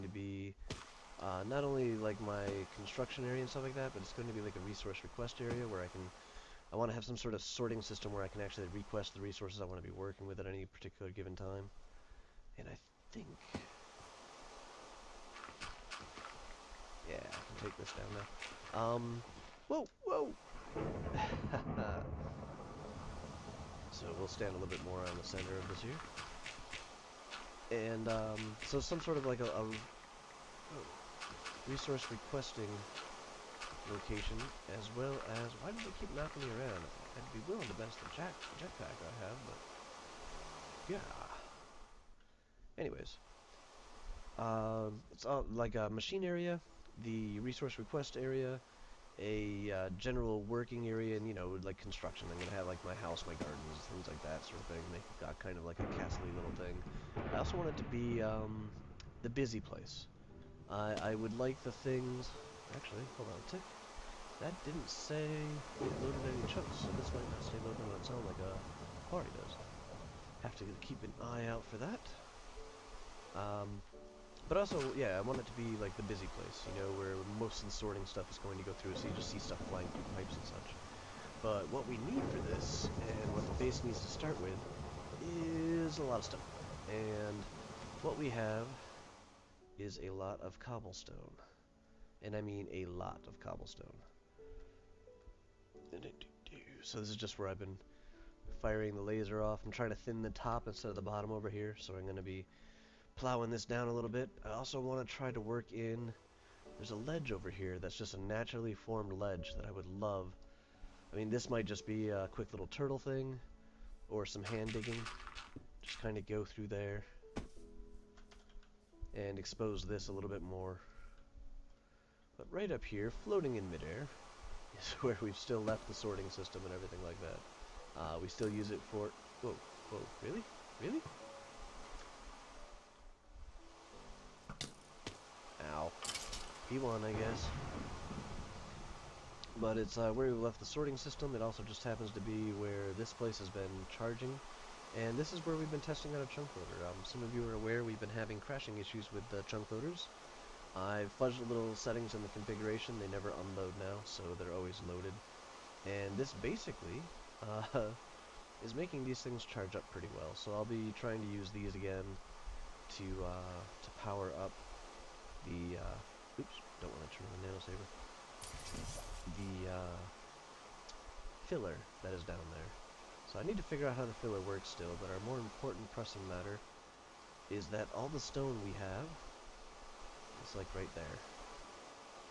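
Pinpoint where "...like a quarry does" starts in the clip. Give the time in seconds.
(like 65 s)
68 s.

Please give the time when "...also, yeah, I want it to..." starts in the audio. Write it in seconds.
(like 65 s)
74 s.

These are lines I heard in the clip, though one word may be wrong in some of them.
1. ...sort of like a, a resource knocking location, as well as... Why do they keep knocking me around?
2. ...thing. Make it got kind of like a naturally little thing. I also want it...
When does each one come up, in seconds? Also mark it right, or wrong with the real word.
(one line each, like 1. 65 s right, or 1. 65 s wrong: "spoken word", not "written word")
1. 28 s wrong: "requesting", not "knocking"
2. 54 s wrong: "castly", not "naturally".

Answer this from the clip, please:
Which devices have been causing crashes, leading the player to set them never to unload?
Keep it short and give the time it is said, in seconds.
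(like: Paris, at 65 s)
Chunk loaders, at 149 s.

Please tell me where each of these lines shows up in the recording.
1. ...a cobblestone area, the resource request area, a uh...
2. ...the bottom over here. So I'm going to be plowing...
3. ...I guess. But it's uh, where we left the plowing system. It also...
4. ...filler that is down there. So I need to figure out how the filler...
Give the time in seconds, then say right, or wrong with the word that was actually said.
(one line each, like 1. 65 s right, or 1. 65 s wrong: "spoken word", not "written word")
1. 45 s wrong: "machine", not "cobblestone"
2. 100 s right
3. 137 s wrong: "sorting", not "plowing"
4. 171 s right.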